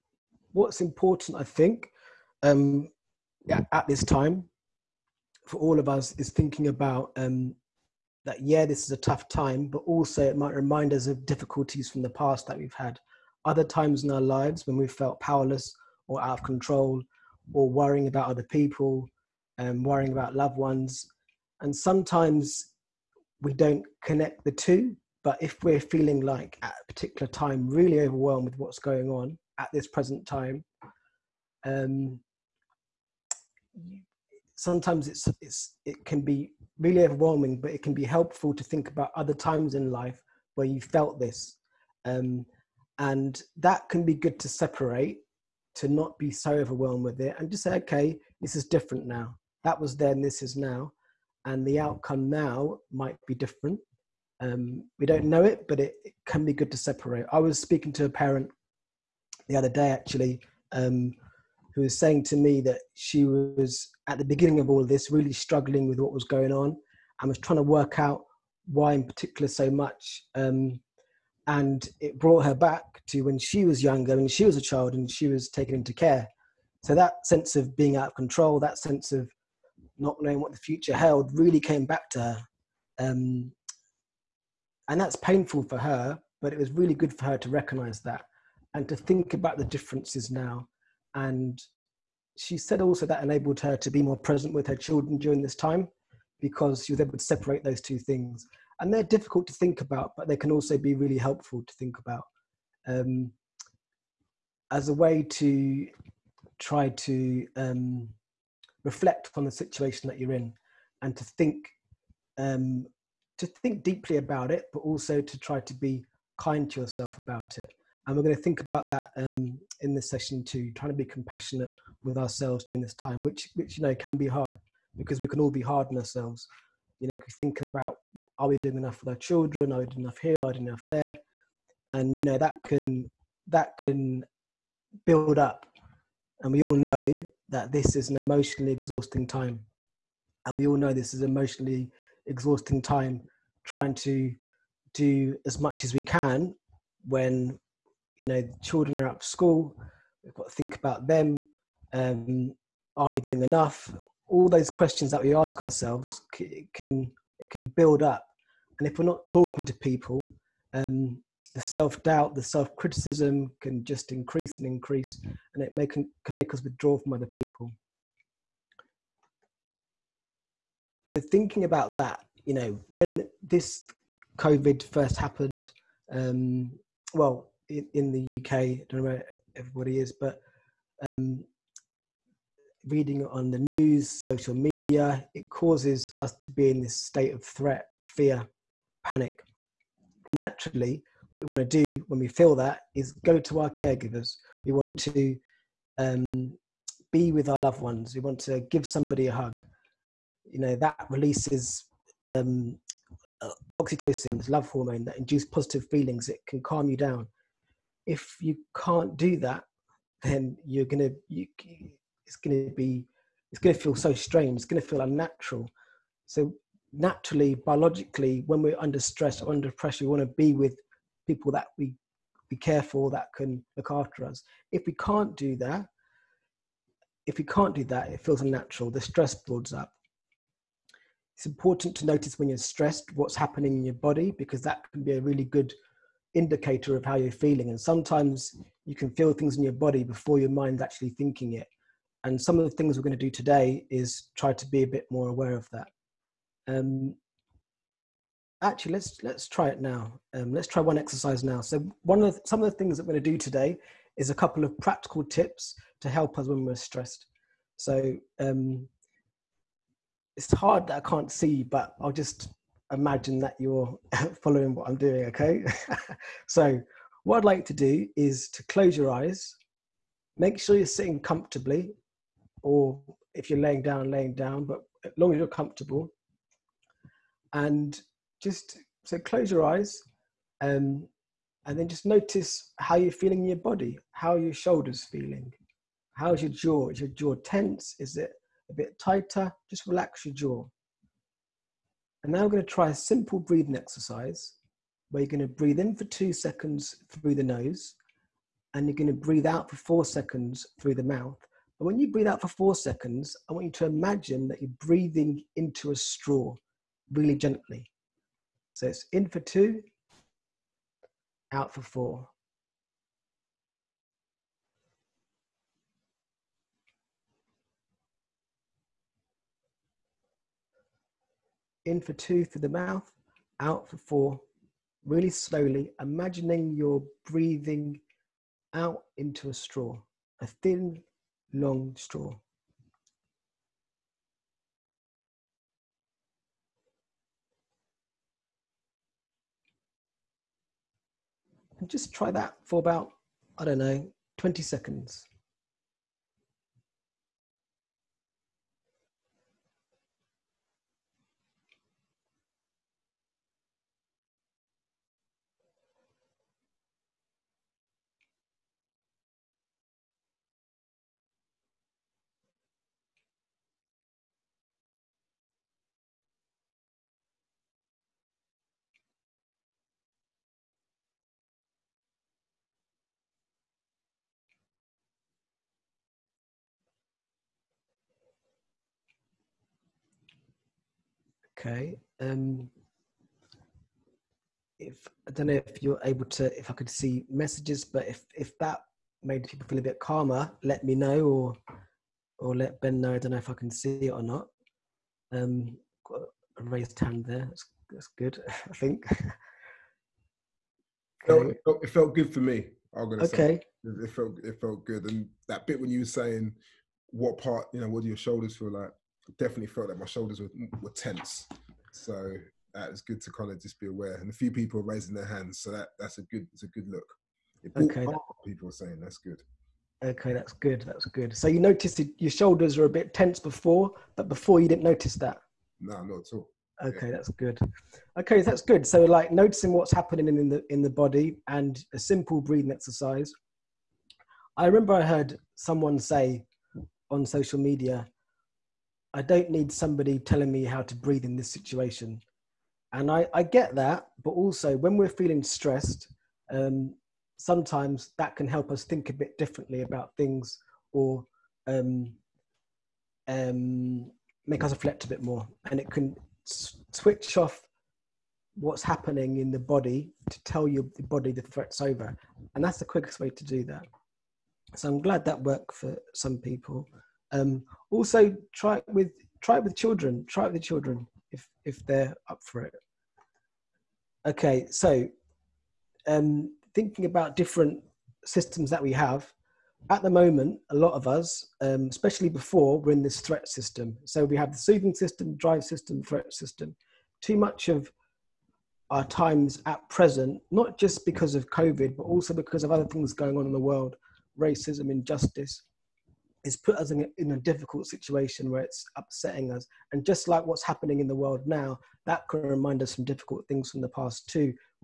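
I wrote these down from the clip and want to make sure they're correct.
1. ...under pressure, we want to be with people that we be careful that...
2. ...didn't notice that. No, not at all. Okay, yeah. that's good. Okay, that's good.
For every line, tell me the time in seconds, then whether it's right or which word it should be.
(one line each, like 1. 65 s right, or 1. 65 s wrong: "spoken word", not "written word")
1. 219 s right
2. 424 s right.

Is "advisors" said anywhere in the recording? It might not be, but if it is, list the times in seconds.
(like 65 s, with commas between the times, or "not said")
not said.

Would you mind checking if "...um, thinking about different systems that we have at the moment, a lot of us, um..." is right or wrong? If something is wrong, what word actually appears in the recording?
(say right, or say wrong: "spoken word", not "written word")
right.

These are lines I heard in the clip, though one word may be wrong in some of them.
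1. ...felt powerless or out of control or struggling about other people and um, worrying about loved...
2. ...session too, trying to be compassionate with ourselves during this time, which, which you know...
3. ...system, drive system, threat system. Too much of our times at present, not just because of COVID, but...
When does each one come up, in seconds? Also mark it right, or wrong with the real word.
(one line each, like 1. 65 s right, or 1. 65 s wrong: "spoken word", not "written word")
1. 14 s wrong: "worrying", not "struggling"
2. 120 s right
3. 484 s right.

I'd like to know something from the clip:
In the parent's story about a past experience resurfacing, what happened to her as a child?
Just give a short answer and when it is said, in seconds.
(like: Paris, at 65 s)
taken into care, at 75 s.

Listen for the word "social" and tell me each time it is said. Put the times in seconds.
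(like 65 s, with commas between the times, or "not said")
184 s, 437 s.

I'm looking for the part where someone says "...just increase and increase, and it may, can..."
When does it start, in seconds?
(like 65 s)
163 s.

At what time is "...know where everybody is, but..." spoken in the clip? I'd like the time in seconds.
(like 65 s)
179 s.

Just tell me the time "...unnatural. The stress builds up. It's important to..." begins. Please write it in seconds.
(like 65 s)
228 s.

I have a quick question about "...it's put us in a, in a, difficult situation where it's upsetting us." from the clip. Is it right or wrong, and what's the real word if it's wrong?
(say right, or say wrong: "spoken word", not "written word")
right.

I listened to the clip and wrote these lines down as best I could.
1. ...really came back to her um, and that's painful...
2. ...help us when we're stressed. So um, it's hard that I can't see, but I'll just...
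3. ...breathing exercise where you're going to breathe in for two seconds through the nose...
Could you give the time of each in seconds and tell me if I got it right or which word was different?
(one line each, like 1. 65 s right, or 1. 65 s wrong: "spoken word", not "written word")
1. 81 s right
2. 256 s right
3. 293 s right.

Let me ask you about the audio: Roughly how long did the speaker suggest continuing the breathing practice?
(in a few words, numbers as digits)
20 seconds.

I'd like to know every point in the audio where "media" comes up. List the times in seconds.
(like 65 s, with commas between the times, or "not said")
184 s, 437 s.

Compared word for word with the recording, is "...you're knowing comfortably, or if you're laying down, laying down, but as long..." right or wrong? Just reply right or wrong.
wrong.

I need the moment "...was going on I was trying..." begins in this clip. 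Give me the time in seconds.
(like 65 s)
66 s.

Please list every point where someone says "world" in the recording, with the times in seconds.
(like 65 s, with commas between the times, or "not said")
493 s, 501 s.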